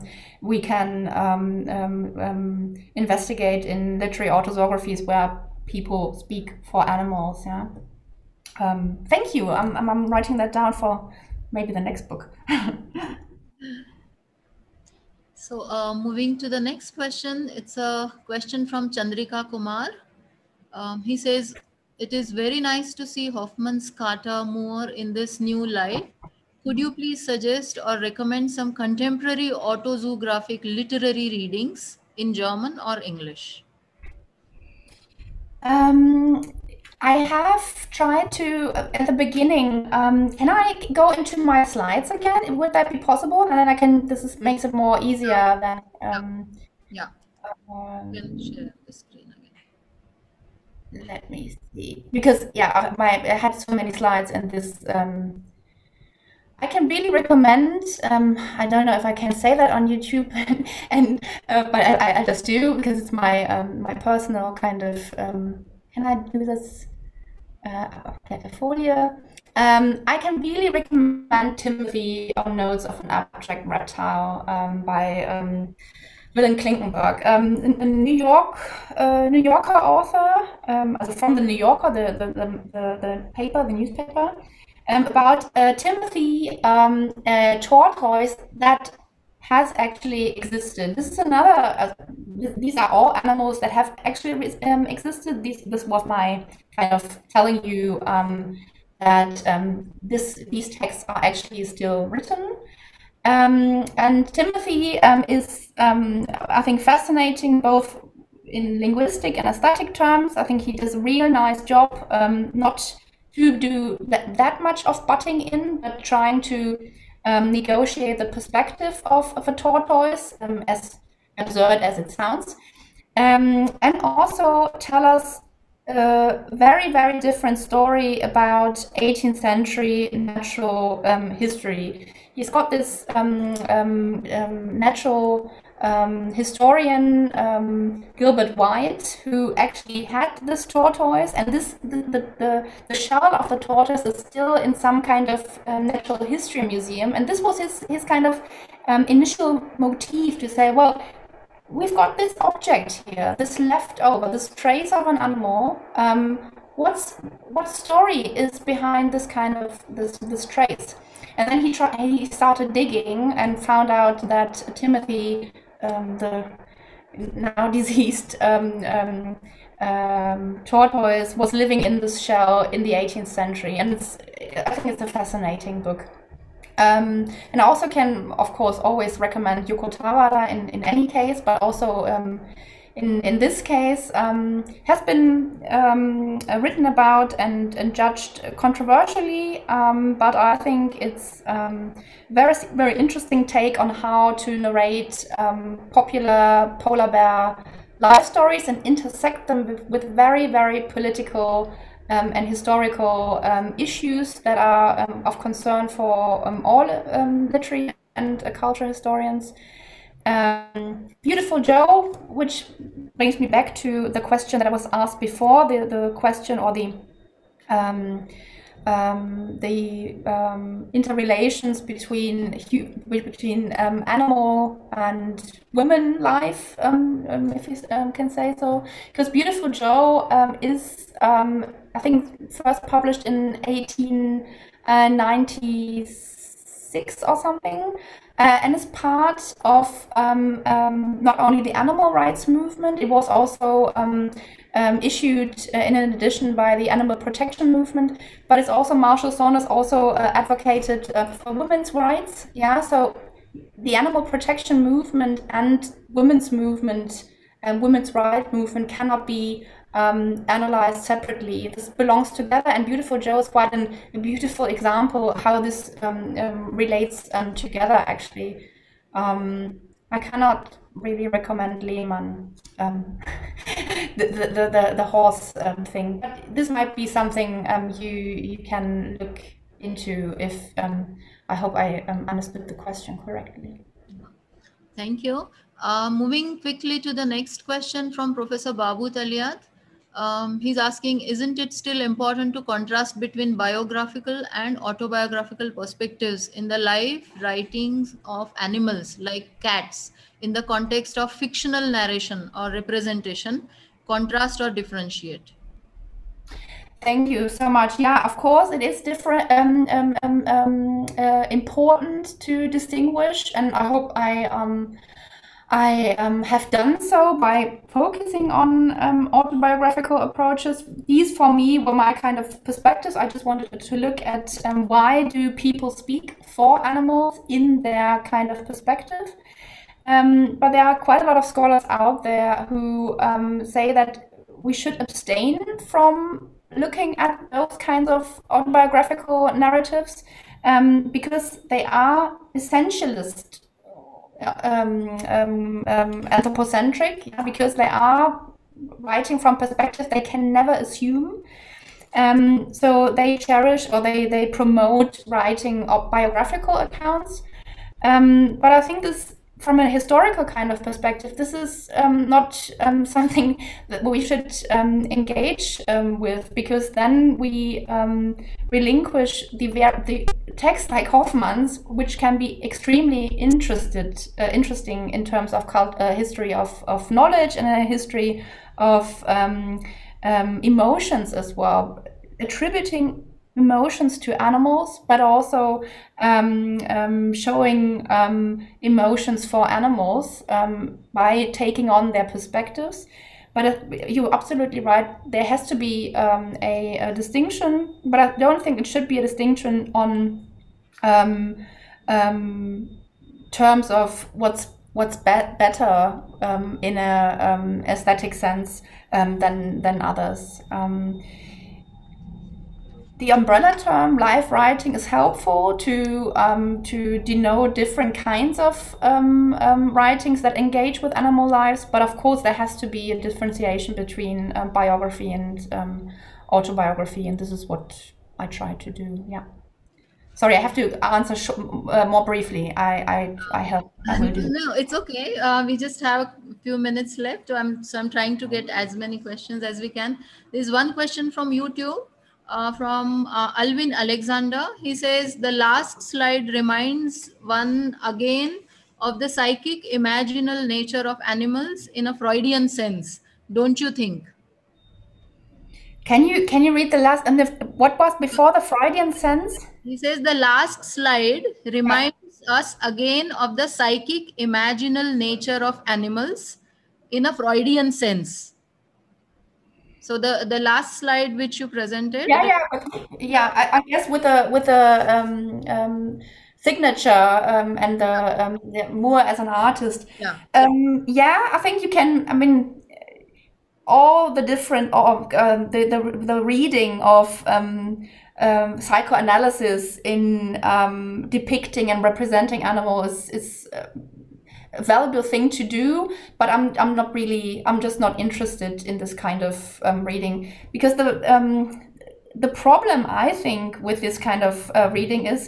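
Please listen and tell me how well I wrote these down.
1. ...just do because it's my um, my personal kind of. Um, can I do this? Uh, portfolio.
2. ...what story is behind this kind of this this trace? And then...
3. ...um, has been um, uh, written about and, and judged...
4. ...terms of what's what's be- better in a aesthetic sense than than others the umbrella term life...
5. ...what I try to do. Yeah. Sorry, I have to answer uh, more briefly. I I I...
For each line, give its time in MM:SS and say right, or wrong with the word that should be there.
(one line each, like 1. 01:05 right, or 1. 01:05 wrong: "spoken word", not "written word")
1. 01:02 right
2. 02:37 right
3. 03:04 right
4. 06:43 right
5. 07:07 right.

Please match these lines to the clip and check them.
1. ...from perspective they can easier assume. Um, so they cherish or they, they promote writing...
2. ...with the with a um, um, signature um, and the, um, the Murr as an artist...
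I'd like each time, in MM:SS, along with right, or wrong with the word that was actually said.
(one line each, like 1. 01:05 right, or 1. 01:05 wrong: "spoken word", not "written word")
1. 05:49 wrong: "never", not "easier"
2. 07:54 right.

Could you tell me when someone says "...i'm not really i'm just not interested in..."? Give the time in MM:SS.
08:16.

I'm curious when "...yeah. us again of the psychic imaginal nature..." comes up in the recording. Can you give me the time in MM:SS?
07:42.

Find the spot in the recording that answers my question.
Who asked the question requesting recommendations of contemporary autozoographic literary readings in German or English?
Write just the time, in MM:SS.
00:18.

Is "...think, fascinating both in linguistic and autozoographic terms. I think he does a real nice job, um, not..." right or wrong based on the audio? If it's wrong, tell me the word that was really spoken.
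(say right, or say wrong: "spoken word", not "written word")
wrong: "aesthetic", not "autozoographic".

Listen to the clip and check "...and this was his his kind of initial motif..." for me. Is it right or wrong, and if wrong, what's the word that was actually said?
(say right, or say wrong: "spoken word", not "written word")
right.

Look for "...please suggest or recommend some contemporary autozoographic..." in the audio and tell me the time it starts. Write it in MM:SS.
00:26.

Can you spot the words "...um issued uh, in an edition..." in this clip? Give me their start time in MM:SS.
04:04.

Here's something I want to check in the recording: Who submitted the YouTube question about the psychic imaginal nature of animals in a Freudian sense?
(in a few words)
Alvin Alexander.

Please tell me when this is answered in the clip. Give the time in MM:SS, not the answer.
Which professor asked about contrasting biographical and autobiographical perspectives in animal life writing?
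04:48.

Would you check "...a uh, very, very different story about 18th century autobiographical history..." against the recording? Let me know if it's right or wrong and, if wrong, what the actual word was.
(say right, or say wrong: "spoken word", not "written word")
wrong: "natural", not "autobiographical".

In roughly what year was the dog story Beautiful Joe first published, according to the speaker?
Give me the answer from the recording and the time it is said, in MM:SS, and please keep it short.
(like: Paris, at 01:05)
1896, at 03:53.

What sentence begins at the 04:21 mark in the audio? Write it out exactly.
This belongs together, and Beautiful Joe is quite an, a beautiful example how this um, um, relates um, together.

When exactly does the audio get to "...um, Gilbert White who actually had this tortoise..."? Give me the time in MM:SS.
02:17.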